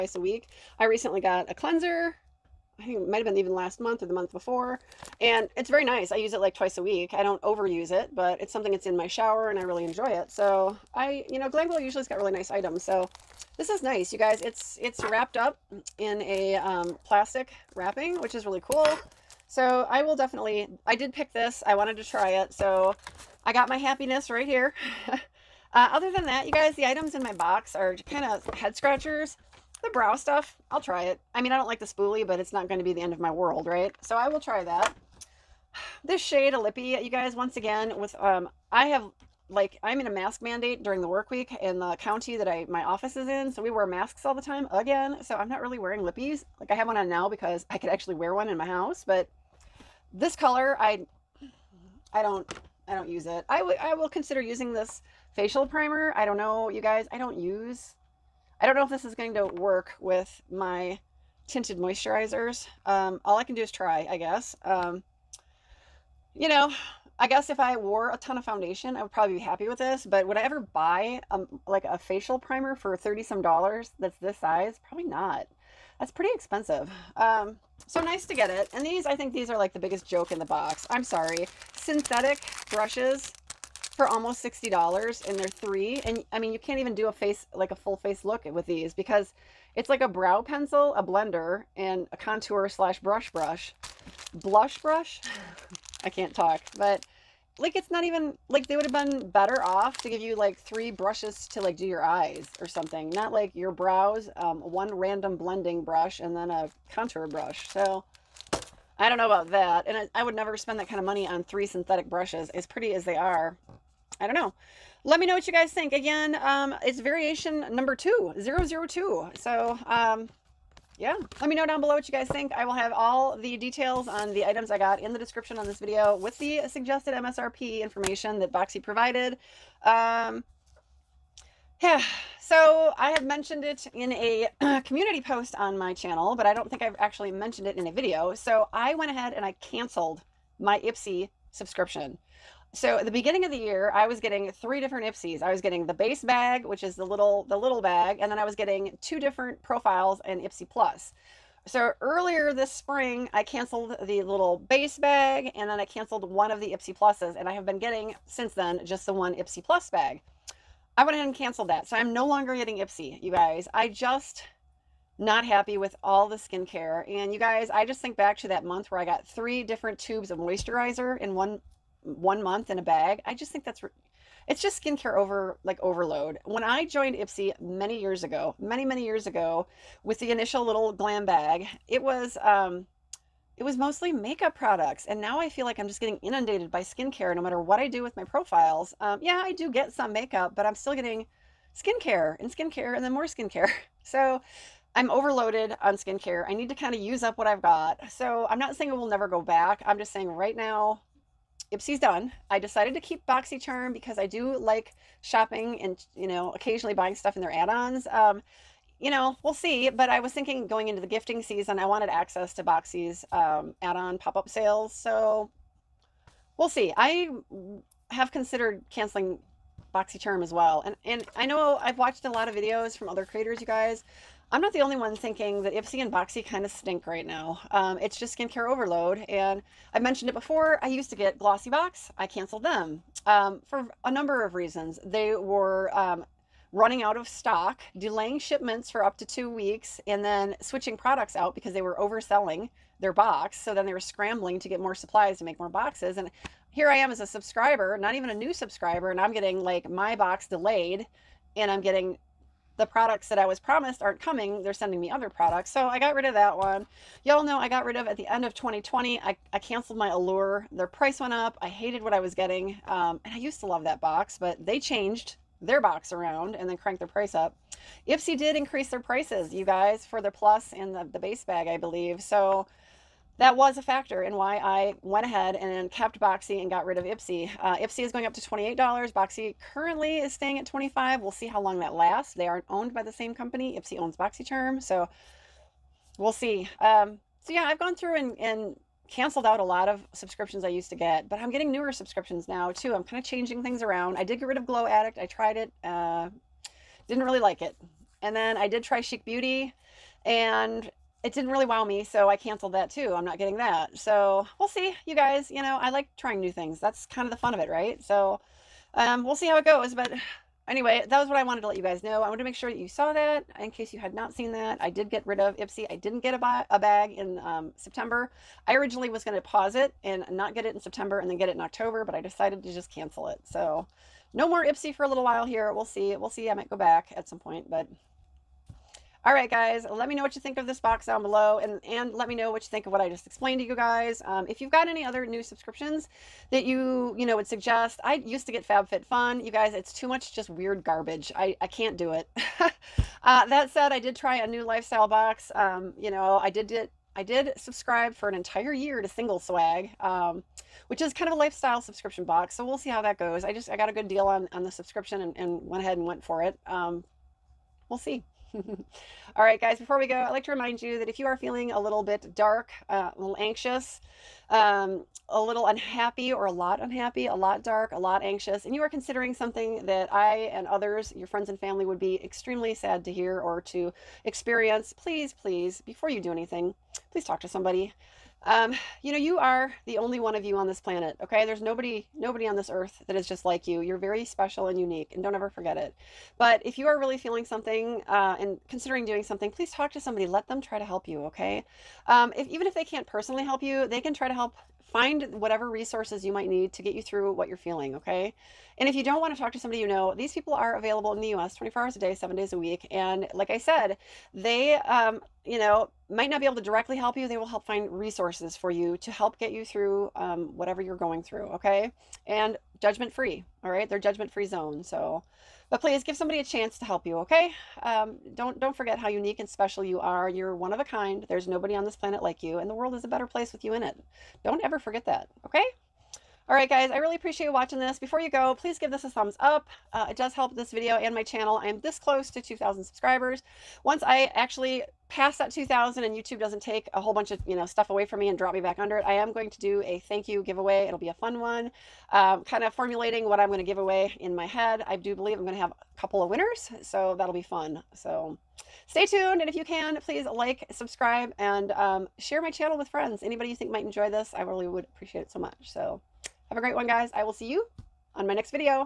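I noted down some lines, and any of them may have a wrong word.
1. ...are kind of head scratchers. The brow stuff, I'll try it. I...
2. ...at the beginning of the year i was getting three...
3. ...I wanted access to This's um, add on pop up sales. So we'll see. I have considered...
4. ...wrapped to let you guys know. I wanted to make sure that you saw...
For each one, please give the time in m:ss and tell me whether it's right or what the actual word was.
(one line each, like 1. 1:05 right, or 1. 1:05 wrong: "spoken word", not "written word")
1. 0:27 right
2. 2:22 right
3. 3:31 wrong: "Boxy", not "This"
4. 5:11 wrong: "wanted", not "wrapped".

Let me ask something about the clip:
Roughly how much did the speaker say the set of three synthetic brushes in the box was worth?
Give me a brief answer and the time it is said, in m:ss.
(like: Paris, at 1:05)
almost $60, at 1:24.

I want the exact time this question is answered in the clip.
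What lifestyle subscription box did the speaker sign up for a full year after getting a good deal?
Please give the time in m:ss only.
5:49.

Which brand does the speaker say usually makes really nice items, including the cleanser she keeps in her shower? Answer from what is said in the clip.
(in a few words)
Glam Glow.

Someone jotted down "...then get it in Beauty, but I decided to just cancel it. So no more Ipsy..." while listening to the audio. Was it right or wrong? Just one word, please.
wrong.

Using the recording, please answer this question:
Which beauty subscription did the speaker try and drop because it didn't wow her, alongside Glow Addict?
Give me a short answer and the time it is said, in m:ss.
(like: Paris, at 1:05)
Chic Beauty, at 4:58.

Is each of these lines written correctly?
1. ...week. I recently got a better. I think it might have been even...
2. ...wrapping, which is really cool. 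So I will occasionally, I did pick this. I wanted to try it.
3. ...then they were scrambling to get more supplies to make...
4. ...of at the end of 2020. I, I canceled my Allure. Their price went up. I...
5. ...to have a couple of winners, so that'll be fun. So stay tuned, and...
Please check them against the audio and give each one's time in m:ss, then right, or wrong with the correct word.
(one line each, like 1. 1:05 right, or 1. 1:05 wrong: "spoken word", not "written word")
1. 0:00 wrong: "cleanser", not "better"
2. 0:17 wrong: "definitely", not "occasionally"
3. 4:03 right
4. 4:17 right
5. 7:25 right.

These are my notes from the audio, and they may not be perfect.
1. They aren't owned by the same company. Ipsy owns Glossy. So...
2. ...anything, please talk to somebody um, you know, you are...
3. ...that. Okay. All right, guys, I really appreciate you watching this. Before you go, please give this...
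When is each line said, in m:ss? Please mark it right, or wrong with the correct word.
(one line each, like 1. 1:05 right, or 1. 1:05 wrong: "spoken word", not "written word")
1. 4:42 wrong: "BoxyCharm", not "Glossy"
2. 6:16 right
3. 7:05 right.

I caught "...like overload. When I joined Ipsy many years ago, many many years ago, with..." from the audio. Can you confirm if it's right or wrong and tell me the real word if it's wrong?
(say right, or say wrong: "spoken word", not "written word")
right.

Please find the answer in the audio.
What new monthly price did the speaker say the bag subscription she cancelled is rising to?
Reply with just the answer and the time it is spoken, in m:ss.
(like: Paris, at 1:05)
$28, at 4:38.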